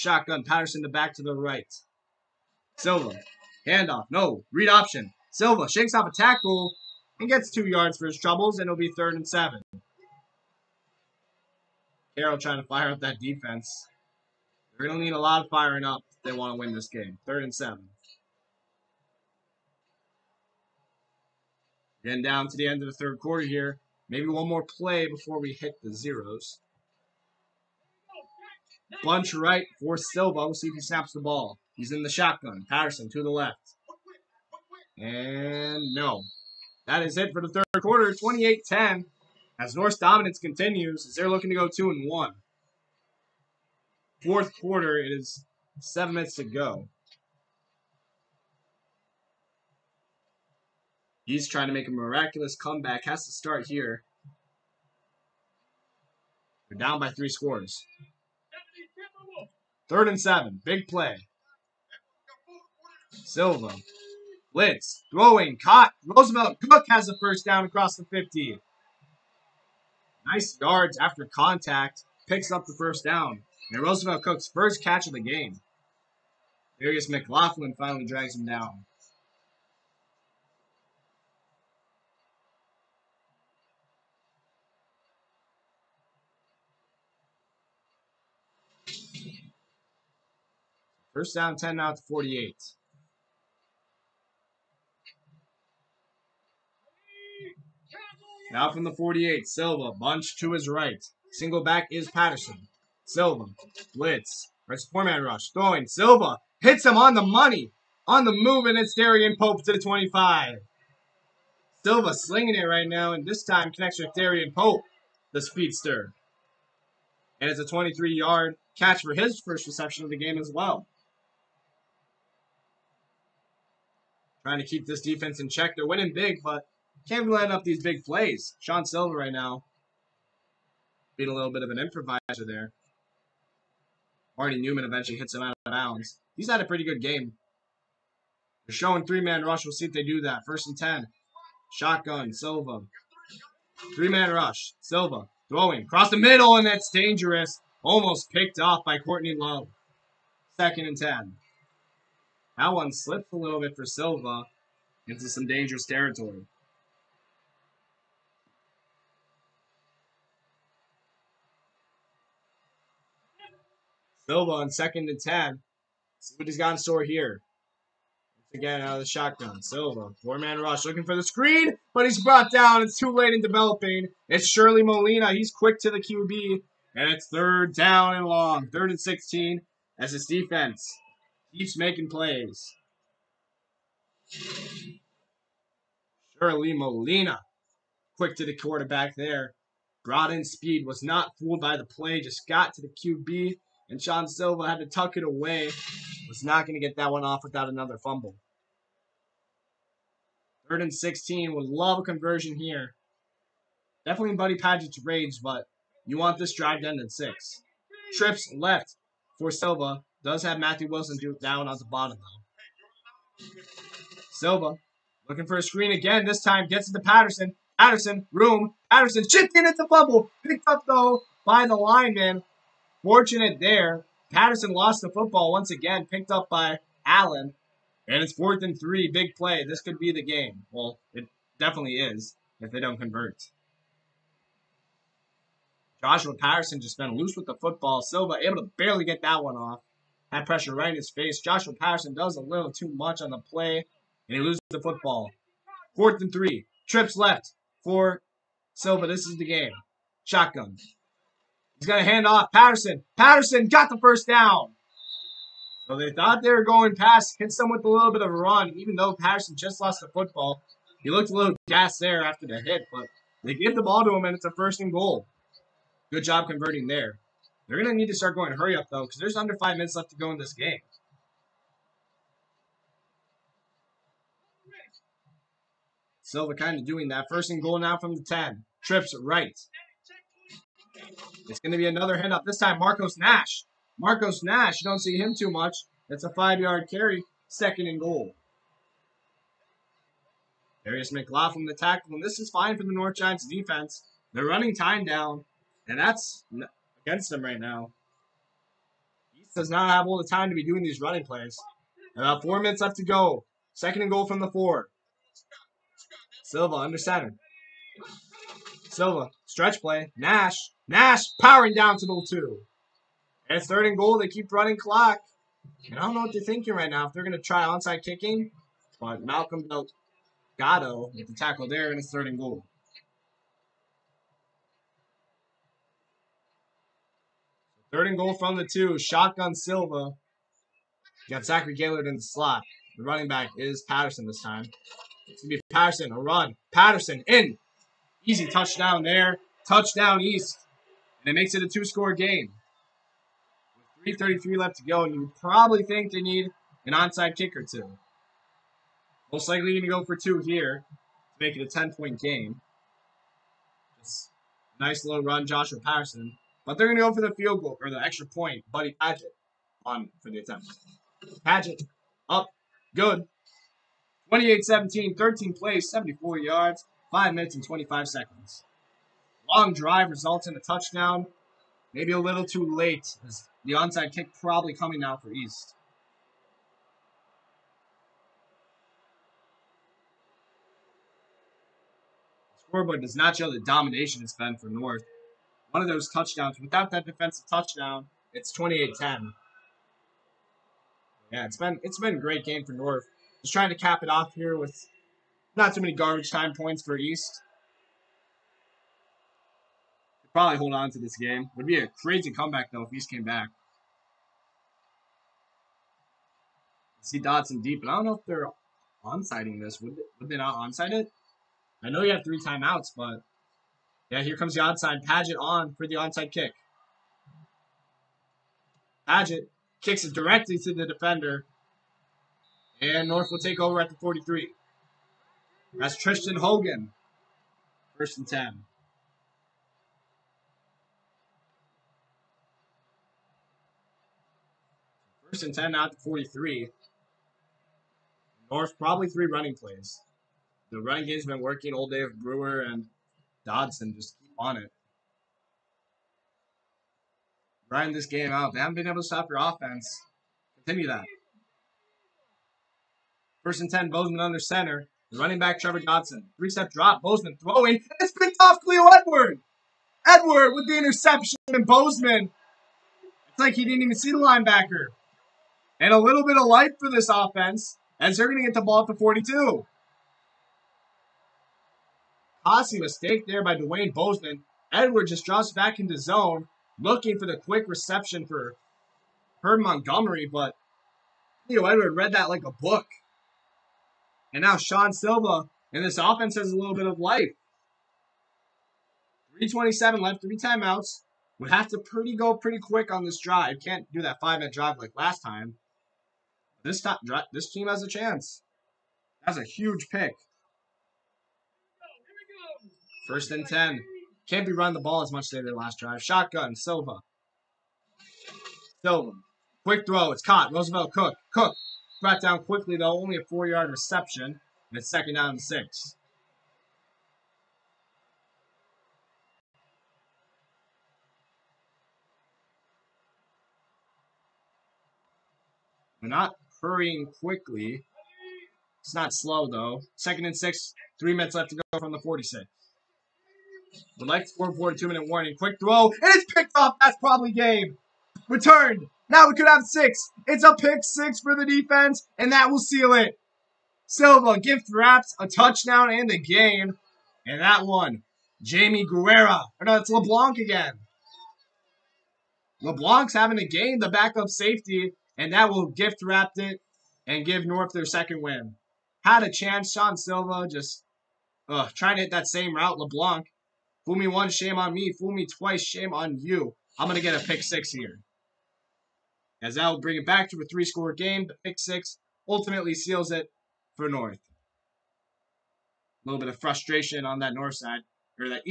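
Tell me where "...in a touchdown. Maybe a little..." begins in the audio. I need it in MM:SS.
06:10.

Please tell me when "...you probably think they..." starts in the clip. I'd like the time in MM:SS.
05:45.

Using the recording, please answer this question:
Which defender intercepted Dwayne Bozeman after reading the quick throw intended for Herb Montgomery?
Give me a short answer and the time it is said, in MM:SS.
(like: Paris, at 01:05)
Cleo Edward, at 07:38.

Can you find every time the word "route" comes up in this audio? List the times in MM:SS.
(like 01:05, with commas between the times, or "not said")
09:22.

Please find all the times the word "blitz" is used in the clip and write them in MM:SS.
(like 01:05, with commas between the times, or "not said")
01:04, 01:43.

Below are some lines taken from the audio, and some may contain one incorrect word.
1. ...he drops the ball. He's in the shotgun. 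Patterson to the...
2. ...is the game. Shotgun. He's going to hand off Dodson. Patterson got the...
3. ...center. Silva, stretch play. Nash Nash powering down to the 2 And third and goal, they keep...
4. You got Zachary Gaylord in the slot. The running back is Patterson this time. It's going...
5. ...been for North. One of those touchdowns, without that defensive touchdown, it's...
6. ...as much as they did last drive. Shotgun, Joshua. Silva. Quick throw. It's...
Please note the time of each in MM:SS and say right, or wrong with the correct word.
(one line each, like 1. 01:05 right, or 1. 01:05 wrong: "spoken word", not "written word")
1. 00:30 wrong: "snaps", not "drops"
2. 04:09 wrong: "Patterson", not "Dodson"
3. 05:06 right
4. 05:31 right
5. 06:24 right
6. 08:25 wrong: "Silva", not "Joshua".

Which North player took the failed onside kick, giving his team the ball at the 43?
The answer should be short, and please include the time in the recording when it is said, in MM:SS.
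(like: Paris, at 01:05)
Tristan Hogan, at 07:05.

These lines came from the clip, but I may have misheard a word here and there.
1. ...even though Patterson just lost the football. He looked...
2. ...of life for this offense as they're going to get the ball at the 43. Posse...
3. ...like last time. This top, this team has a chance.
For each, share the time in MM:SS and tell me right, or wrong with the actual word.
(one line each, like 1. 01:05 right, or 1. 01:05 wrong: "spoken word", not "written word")
1. 04:18 right
2. 07:46 wrong: "42", not "43"
3. 08:14 right.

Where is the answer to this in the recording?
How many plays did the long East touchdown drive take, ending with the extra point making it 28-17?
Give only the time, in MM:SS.
06:05.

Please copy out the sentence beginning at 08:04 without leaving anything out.
And now Sean Silva and this offense has a little bit of life.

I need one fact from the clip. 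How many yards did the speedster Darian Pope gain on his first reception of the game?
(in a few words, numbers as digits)
23.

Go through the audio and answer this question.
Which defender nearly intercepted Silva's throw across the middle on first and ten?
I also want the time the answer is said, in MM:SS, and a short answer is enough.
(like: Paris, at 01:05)
Courtney Love, at 02:28.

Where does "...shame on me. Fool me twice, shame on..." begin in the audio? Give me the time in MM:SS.
09:24.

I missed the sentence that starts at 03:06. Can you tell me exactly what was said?
Shirley Molina, quick to the quarterback there.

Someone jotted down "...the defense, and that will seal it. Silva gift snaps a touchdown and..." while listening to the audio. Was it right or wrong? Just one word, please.
wrong.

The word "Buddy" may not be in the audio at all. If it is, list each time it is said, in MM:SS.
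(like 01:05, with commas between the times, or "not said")
03:24, 05:58.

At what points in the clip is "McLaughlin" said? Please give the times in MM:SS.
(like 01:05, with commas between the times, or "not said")
01:17, 04:51.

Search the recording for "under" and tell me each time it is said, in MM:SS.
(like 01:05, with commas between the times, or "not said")
04:29, 05:06, 07:34.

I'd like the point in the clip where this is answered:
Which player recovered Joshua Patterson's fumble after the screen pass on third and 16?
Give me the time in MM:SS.
03:46.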